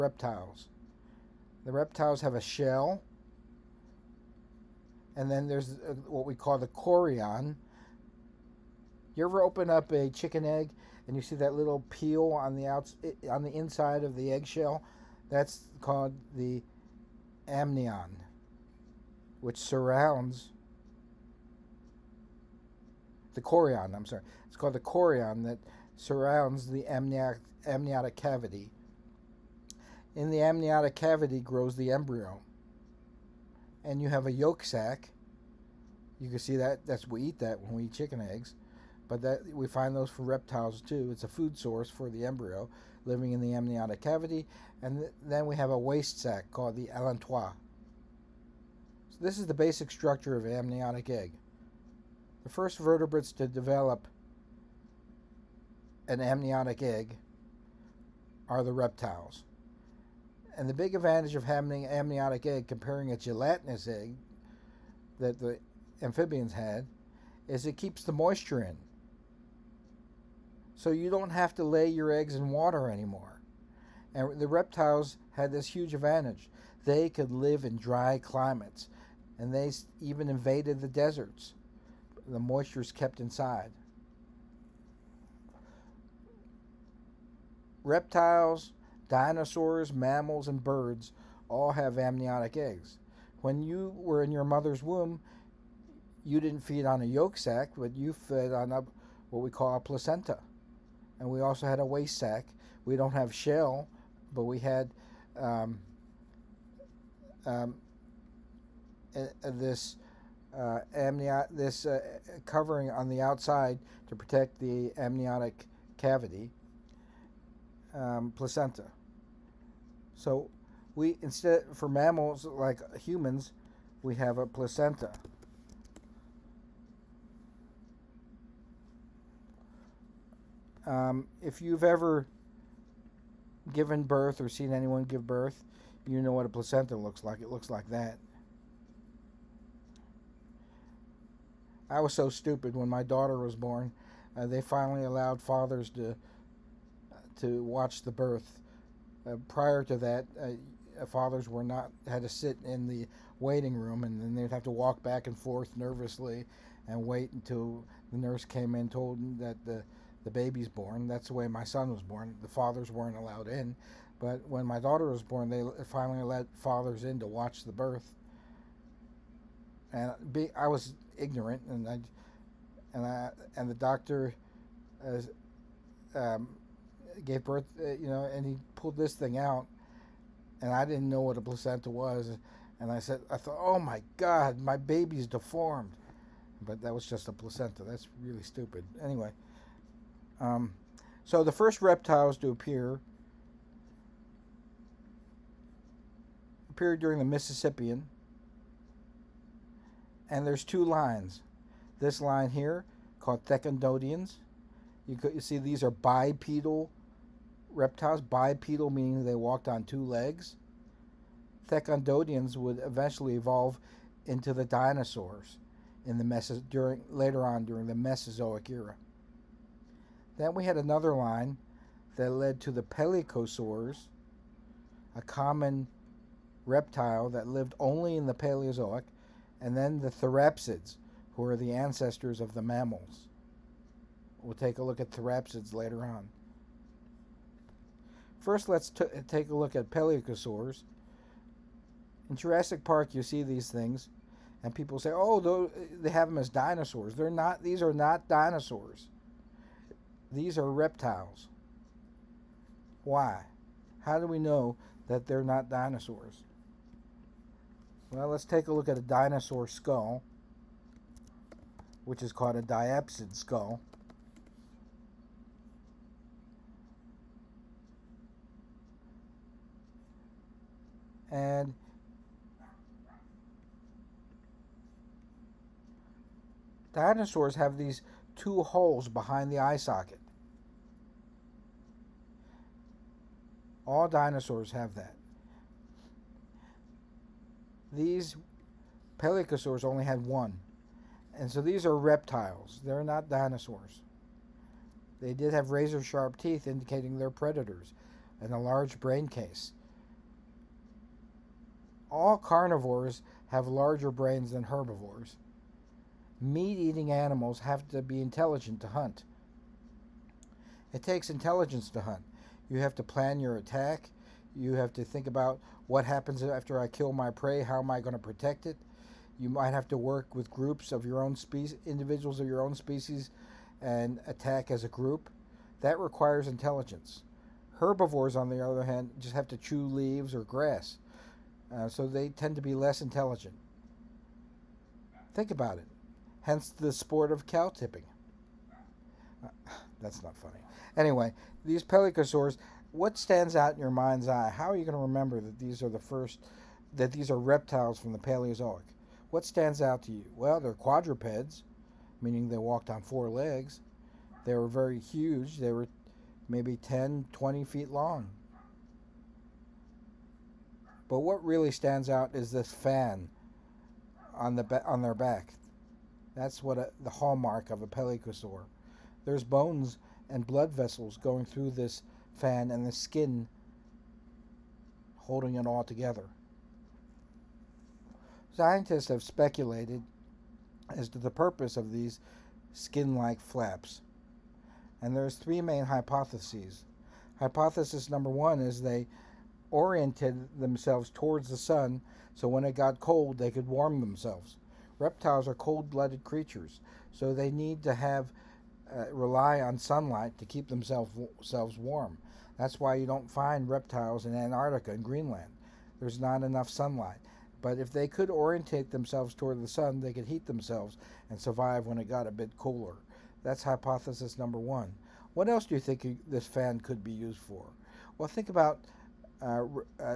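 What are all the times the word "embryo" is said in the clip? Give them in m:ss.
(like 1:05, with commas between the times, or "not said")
0:31, 0:42.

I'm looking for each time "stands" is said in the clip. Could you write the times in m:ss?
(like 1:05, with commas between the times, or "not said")
5:43, 5:49, 6:01.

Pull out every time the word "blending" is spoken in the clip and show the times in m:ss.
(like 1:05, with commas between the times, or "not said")
not said.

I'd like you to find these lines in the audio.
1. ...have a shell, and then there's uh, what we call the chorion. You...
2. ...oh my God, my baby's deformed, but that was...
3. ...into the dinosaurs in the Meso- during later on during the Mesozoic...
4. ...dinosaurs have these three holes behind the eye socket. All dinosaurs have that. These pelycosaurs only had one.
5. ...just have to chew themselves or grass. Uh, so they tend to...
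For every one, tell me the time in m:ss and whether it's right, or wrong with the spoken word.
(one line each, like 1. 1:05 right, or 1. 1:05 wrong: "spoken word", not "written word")
1. 0:02 right
2. 3:03 right
3. 3:34 right
4. 4:36 wrong: "two", not "three"
5. 5:29 wrong: "leaves", not "themselves".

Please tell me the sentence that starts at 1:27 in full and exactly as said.
Reptiles, dinosaurs, mammals, and birds all have amniotic eggs.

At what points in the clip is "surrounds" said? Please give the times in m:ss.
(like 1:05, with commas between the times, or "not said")
0:19, 0:25.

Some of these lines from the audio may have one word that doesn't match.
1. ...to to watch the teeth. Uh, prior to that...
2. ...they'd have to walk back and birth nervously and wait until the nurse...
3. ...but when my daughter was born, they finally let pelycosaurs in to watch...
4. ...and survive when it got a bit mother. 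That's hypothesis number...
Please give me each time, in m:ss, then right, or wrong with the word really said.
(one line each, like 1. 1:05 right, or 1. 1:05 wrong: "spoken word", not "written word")
1. 2:25 wrong: "birth", not "teeth"
2. 2:34 wrong: "forth", not "birth"
3. 2:44 wrong: "fathers", not "pelycosaurs"
4. 6:51 wrong: "cooler", not "mother".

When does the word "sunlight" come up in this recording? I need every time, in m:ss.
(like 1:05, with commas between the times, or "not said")
6:39, 6:46.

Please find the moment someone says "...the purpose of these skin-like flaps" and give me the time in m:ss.
6:21.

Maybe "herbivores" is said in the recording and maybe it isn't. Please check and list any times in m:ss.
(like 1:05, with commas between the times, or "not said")
5:04, 5:27.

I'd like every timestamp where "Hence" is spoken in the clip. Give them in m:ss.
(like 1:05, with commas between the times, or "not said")
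5:36.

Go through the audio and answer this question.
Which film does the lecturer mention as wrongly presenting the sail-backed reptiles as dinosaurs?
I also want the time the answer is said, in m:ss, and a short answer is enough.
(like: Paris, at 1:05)
Jurassic Park, at 4:02.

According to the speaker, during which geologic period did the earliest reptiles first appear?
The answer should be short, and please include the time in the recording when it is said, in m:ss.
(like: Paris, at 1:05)
Mississippian, at 3:17.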